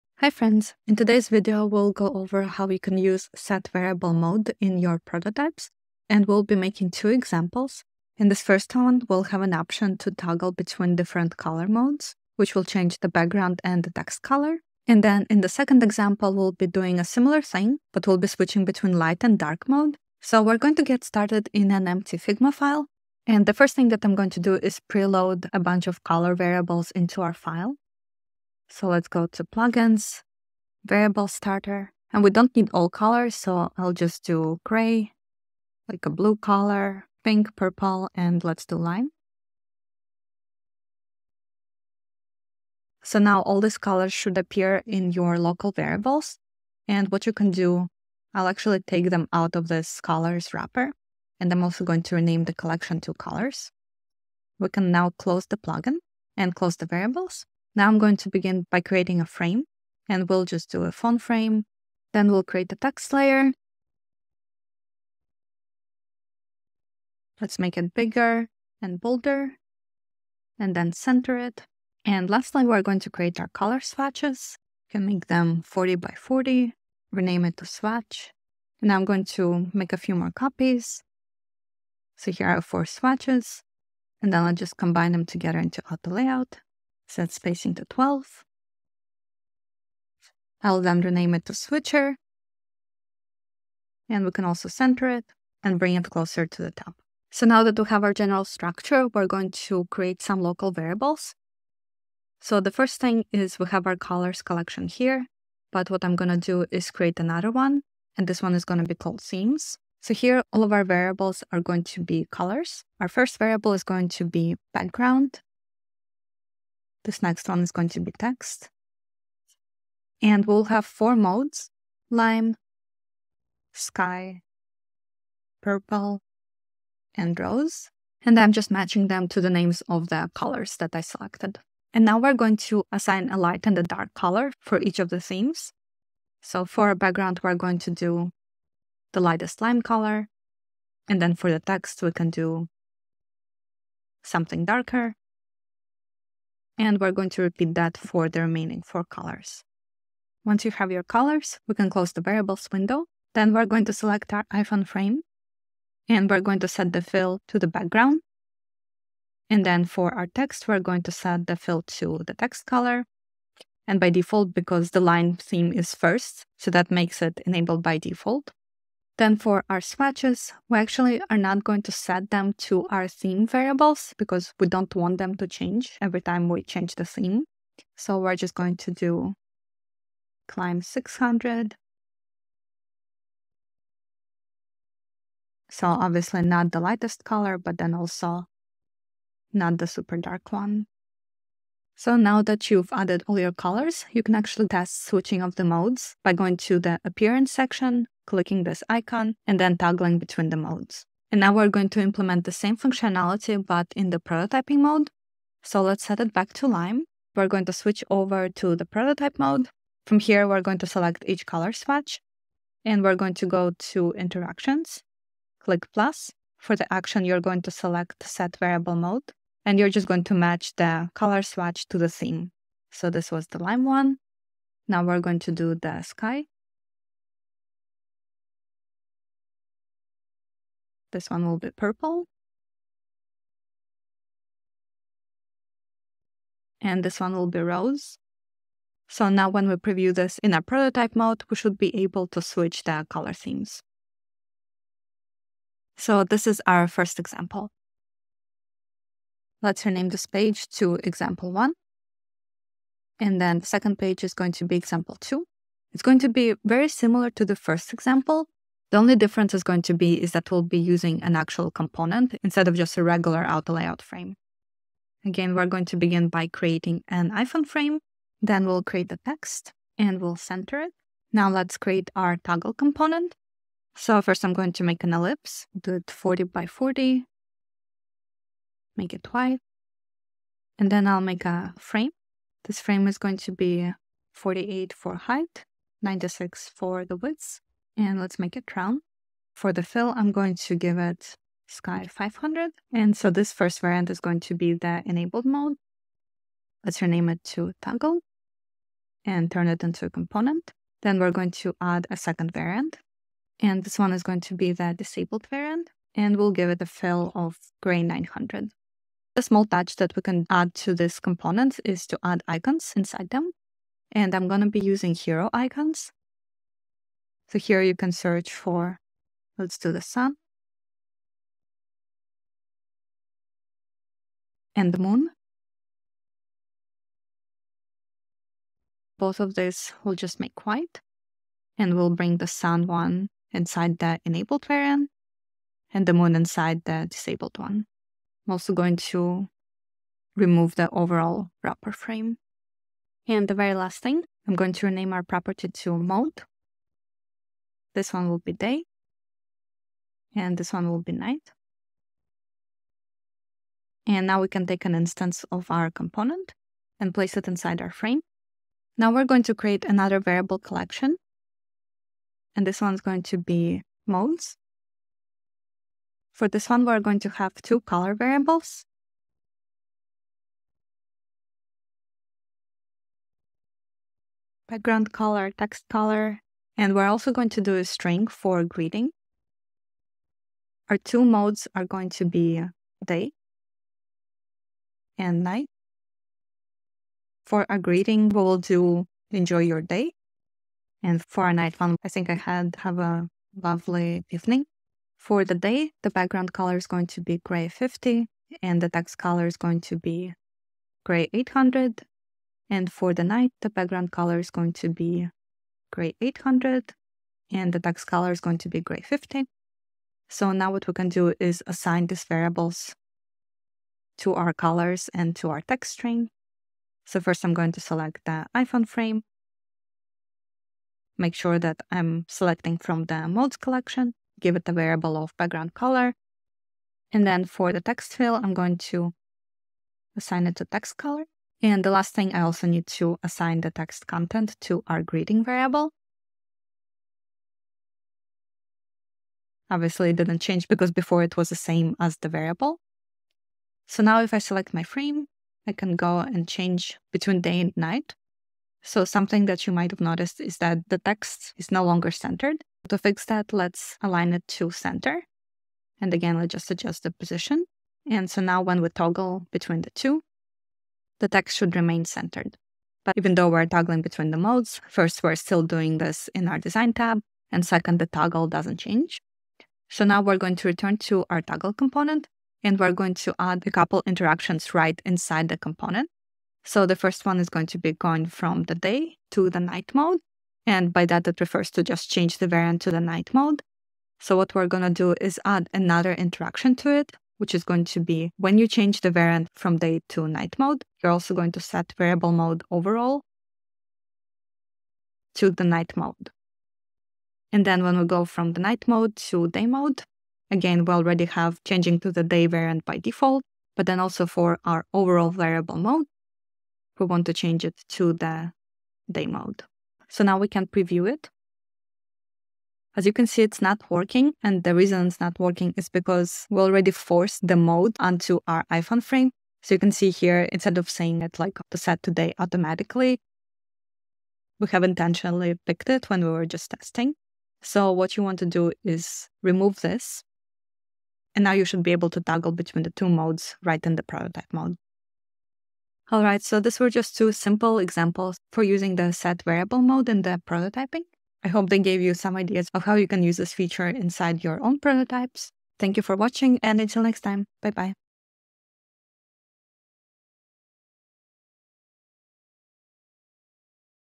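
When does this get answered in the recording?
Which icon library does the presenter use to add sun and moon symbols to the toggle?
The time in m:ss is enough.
5:15.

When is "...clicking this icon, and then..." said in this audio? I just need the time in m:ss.
3:18.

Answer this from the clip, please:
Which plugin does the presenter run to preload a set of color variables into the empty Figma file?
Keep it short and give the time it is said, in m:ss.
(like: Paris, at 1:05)
Variable starter, at 0:30.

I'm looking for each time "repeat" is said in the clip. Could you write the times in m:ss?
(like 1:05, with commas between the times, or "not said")
2:27.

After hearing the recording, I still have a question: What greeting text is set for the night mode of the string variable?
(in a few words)
Have a lovely evening.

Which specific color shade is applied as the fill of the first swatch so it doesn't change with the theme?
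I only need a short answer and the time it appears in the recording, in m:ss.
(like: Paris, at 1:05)
Lime 600, at 3:00.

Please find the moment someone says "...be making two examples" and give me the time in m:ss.
0:06.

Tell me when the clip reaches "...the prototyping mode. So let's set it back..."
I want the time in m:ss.
3:24.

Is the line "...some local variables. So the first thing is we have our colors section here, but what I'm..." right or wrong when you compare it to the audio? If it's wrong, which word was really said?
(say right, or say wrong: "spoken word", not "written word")
wrong: "collection", not "section".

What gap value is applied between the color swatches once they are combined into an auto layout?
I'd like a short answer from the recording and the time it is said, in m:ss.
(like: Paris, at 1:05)
12, at 1:27.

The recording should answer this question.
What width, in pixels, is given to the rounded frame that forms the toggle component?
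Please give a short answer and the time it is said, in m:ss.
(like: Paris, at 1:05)
96, at 4:46.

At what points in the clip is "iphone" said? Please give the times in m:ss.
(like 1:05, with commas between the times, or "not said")
2:34, 4:27, 6:58, 8:38.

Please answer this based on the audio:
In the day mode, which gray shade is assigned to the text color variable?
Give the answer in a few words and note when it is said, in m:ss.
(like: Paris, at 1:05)
Gray 800, at 6:38.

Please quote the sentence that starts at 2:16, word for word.
So for a background, we're going to do the lightest lime color.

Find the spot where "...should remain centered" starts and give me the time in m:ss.
7:41.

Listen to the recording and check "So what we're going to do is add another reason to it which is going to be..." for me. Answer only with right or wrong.
wrong.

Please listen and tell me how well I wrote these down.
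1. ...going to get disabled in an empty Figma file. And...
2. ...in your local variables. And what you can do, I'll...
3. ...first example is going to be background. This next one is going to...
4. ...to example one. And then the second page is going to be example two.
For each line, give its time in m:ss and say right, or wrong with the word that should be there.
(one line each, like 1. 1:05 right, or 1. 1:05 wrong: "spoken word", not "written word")
1. 0:20 wrong: "started", not "disabled"
2. 0:44 right
3. 1:53 wrong: "variable", not "example"
4. 4:10 right.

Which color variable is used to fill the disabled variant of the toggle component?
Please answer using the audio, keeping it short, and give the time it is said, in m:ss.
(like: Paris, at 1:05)
Gray 900, at 5:07.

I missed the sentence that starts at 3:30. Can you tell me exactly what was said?
From here, we're going to select each color swatch, and we're going to go to interactions, click plus.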